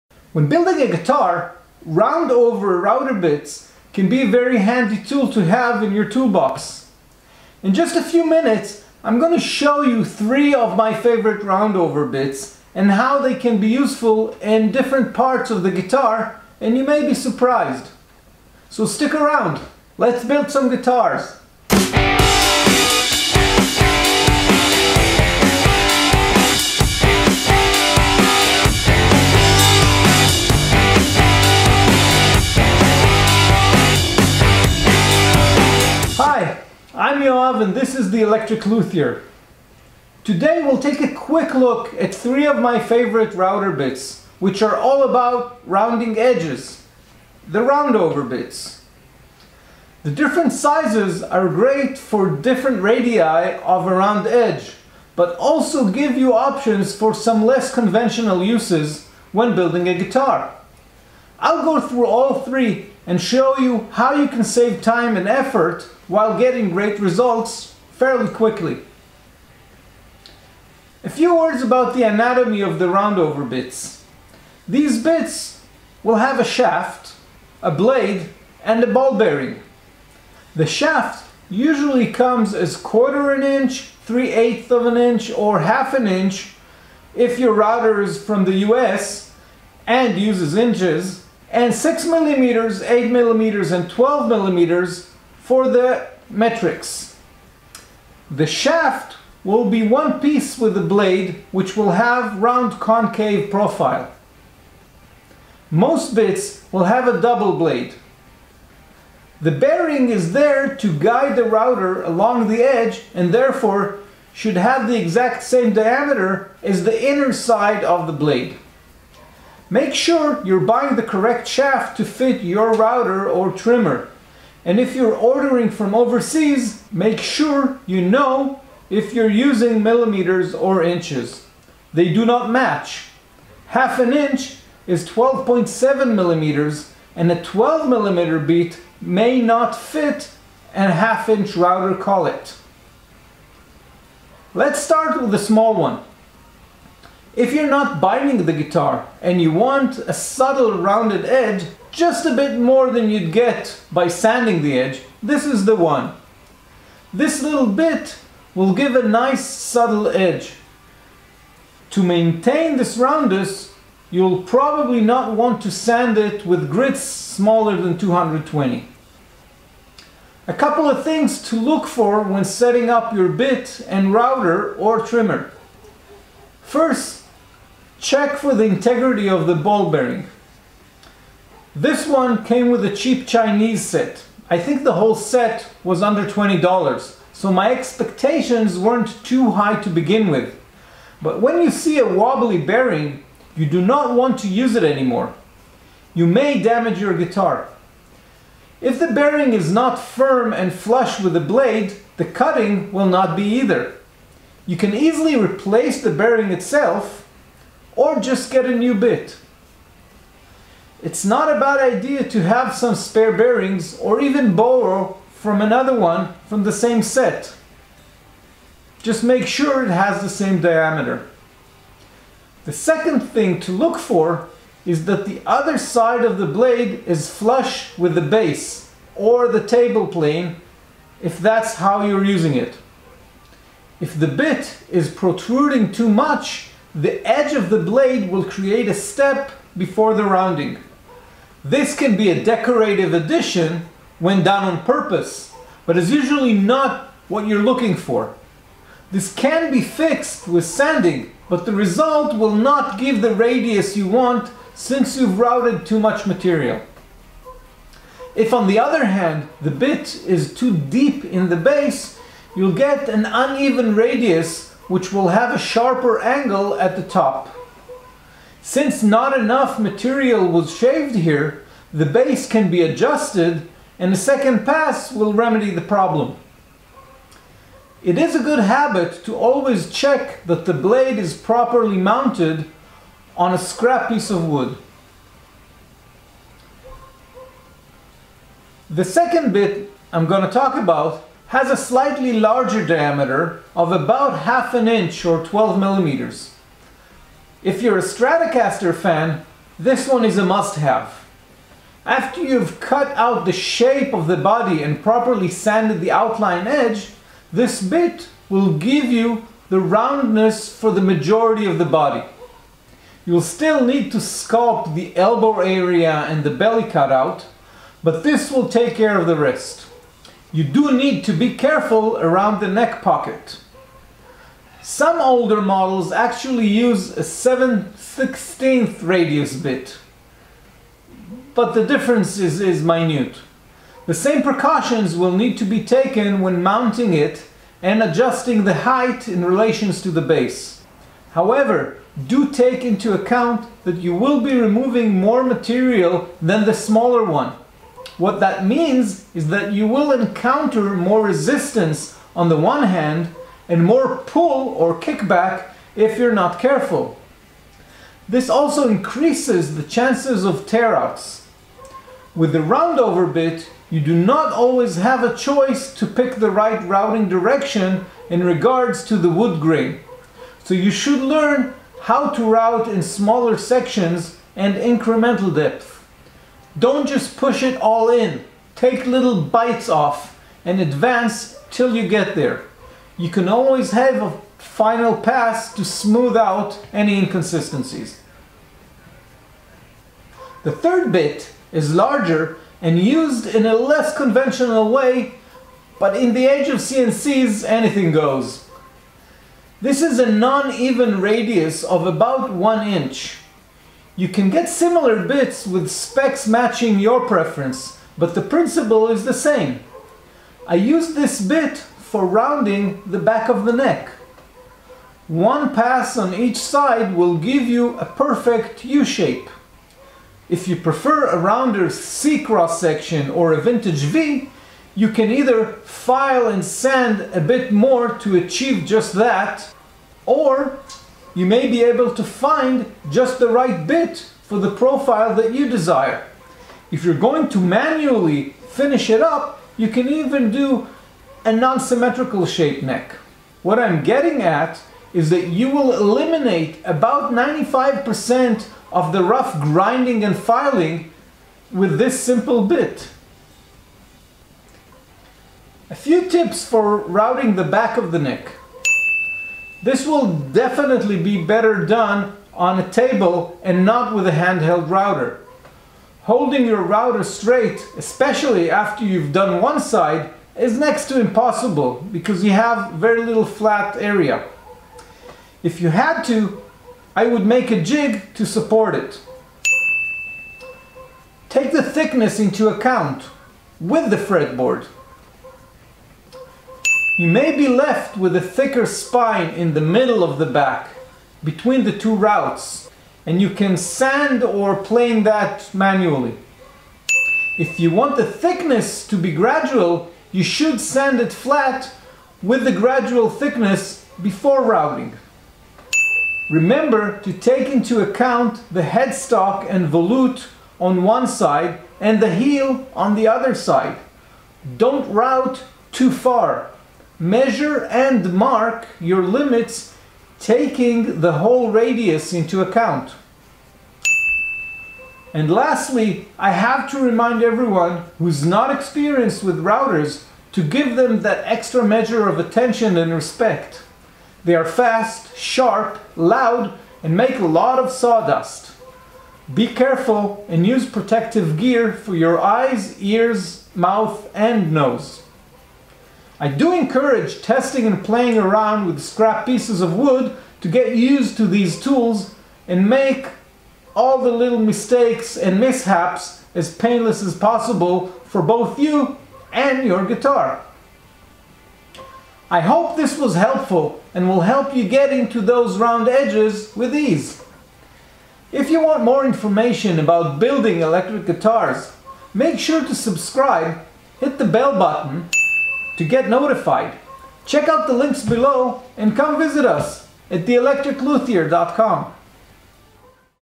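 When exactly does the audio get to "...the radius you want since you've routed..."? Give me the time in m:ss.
4:13.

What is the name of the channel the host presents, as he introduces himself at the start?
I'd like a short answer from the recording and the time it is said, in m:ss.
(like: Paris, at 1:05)
The Electric Luthier, at 0:38.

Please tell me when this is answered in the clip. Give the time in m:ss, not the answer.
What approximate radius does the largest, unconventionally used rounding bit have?
6:42.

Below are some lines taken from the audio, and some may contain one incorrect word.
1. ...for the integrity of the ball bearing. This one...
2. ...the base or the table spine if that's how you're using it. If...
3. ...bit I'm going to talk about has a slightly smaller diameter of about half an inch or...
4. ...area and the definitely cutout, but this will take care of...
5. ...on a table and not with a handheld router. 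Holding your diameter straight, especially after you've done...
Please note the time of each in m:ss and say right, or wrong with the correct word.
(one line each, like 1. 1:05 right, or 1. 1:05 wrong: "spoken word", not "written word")
1. 2:58 right
2. 3:48 wrong: "plane", not "spine"
3. 4:49 wrong: "larger", not "smaller"
4. 5:15 wrong: "belly", not "definitely"
5. 7:42 wrong: "router", not "diameter".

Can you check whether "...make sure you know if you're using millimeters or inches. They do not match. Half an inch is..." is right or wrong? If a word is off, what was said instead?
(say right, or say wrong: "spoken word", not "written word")
right.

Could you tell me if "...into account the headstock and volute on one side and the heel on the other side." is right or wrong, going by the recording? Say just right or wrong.
right.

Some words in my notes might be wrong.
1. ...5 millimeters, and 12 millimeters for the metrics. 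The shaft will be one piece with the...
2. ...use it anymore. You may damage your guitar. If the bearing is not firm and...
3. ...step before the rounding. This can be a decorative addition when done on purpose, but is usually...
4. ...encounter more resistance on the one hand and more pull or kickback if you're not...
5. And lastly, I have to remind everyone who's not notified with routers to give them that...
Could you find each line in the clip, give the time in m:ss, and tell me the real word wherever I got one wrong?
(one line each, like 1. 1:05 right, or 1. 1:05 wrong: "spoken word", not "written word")
1. 1:32 wrong: "8", not "5"
2. 3:14 right
3. 3:58 right
4. 5:50 right
5. 8:45 wrong: "experienced", not "notified".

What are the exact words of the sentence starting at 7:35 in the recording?
A few tips for routing the back of the neck.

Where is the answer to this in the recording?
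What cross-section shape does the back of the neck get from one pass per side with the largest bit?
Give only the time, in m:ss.
6:58.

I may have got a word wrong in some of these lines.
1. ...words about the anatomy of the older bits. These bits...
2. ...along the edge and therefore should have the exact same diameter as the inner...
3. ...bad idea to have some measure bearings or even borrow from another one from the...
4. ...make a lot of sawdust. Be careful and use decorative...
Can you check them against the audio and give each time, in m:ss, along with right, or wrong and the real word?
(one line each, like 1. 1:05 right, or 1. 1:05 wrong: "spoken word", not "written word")
1. 1:11 wrong: "roundover", not "older"
2. 1:52 right
3. 3:31 wrong: "spare", not "measure"
4. 8:57 wrong: "protective", not "decorative".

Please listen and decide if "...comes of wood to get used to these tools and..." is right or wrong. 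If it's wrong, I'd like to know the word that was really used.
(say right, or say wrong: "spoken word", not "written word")
wrong: "pieces", not "comes".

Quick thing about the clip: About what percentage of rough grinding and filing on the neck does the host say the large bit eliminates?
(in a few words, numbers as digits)
95%.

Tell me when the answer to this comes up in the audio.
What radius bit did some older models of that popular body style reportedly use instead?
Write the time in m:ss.
5:27.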